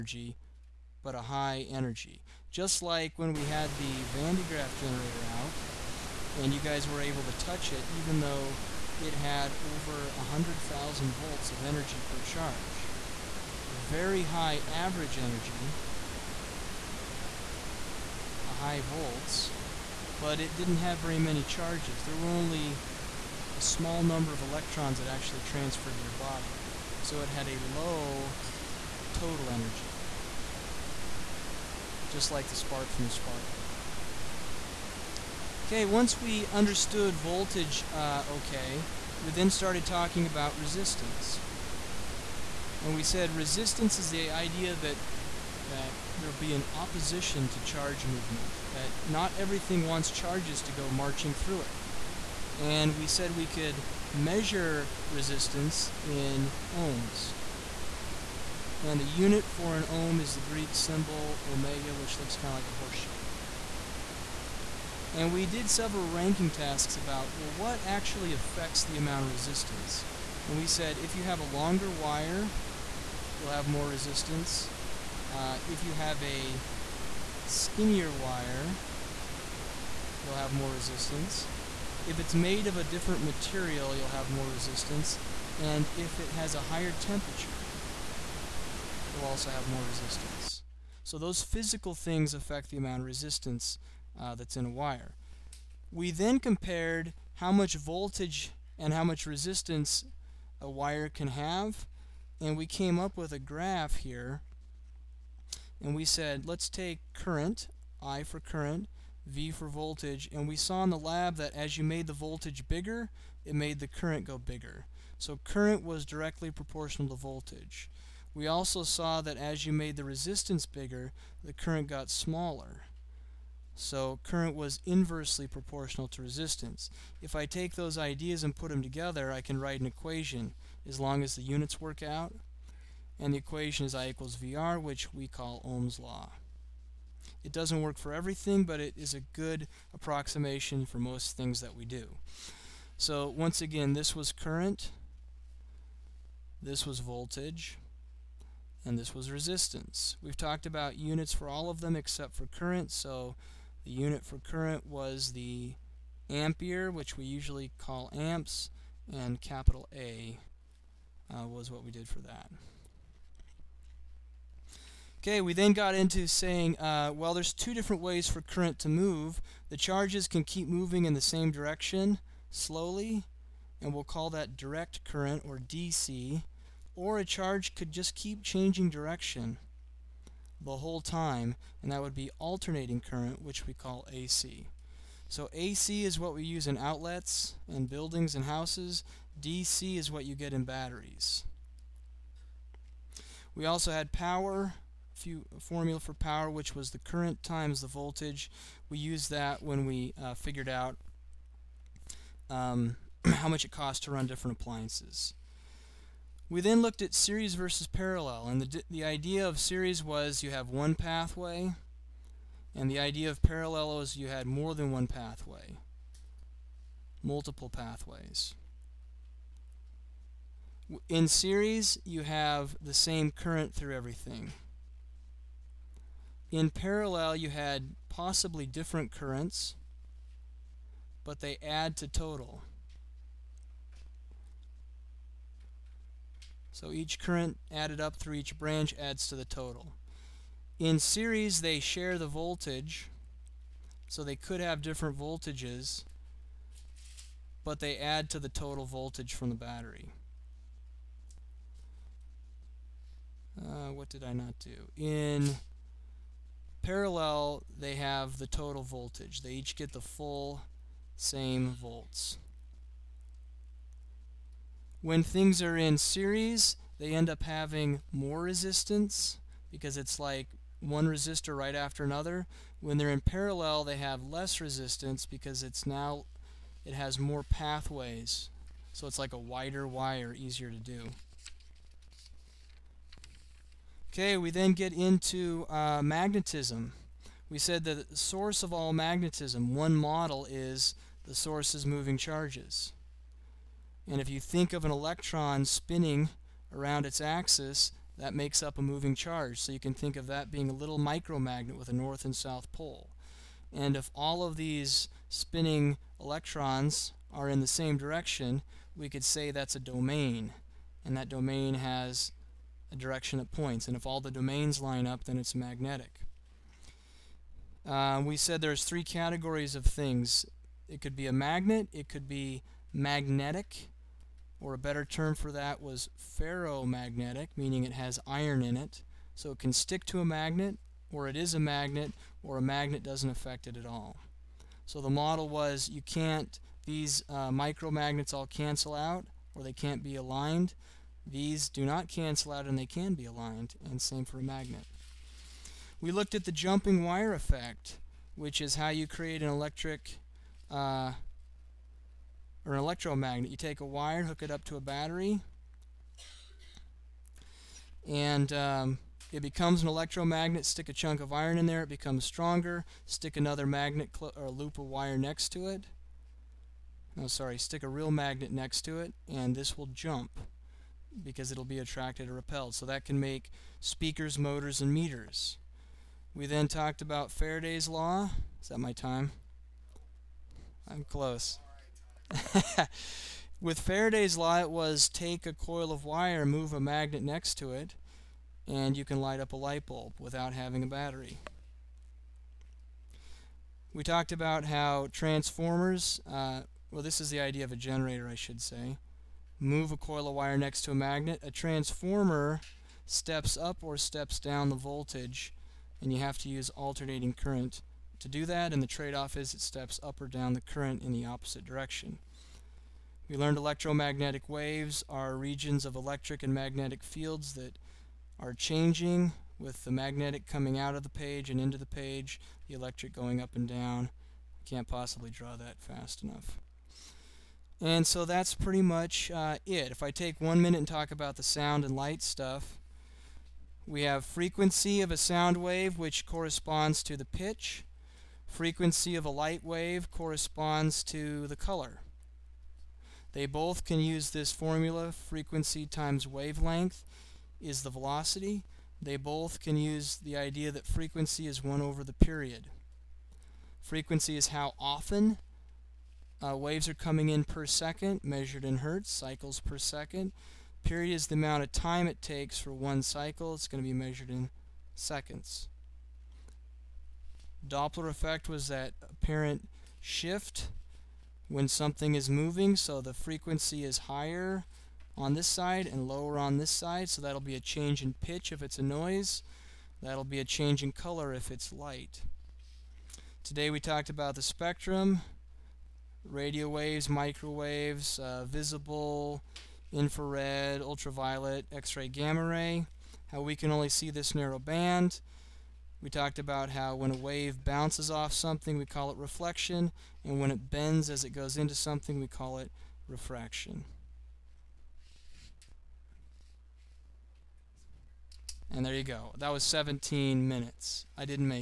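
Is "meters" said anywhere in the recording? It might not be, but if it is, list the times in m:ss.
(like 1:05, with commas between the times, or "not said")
6:14.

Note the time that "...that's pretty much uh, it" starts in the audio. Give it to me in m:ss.
7:08.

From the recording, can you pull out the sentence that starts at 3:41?
In series, you have the same current through everything.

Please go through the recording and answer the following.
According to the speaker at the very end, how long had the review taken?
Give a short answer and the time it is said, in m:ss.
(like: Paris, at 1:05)
17 minutes, at 8:29.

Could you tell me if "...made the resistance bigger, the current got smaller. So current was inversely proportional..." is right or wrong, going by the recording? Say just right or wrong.
right.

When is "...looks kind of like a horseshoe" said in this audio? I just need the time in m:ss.
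1:02.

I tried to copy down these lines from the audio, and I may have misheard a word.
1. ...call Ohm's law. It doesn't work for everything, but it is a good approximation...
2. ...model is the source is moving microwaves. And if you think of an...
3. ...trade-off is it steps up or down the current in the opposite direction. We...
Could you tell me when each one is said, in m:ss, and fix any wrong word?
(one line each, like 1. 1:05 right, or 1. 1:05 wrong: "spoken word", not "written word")
1. 2:15 right
2. 4:49 wrong: "charges", not "microwaves"
3. 6:48 right.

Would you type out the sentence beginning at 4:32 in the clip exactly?
When they're in parallel, they have less resistance because it's now it has more pathways.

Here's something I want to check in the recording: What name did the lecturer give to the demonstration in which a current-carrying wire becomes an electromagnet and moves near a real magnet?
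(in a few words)
jumping wire effect.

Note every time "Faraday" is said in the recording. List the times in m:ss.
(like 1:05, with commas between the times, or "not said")
6:17, 6:23.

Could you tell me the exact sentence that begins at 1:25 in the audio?
And if it has a higher temperature, you'll also have more resistance.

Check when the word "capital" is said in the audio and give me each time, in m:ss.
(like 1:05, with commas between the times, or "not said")
2:39.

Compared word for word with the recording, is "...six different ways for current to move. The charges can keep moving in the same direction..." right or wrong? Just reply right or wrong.
wrong.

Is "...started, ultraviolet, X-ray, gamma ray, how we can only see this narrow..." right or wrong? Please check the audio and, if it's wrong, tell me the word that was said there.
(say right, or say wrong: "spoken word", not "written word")
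wrong: "infrared", not "started".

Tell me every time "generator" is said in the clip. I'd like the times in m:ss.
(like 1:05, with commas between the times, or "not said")
0:04, 6:37.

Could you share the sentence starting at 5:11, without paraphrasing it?
And that domain has a direction that points.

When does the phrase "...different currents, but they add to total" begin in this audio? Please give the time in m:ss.
3:48.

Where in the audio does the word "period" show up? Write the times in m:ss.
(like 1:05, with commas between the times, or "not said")
7:32, 7:40.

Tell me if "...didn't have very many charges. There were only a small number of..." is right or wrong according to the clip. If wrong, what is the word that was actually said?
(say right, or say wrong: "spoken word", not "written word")
right.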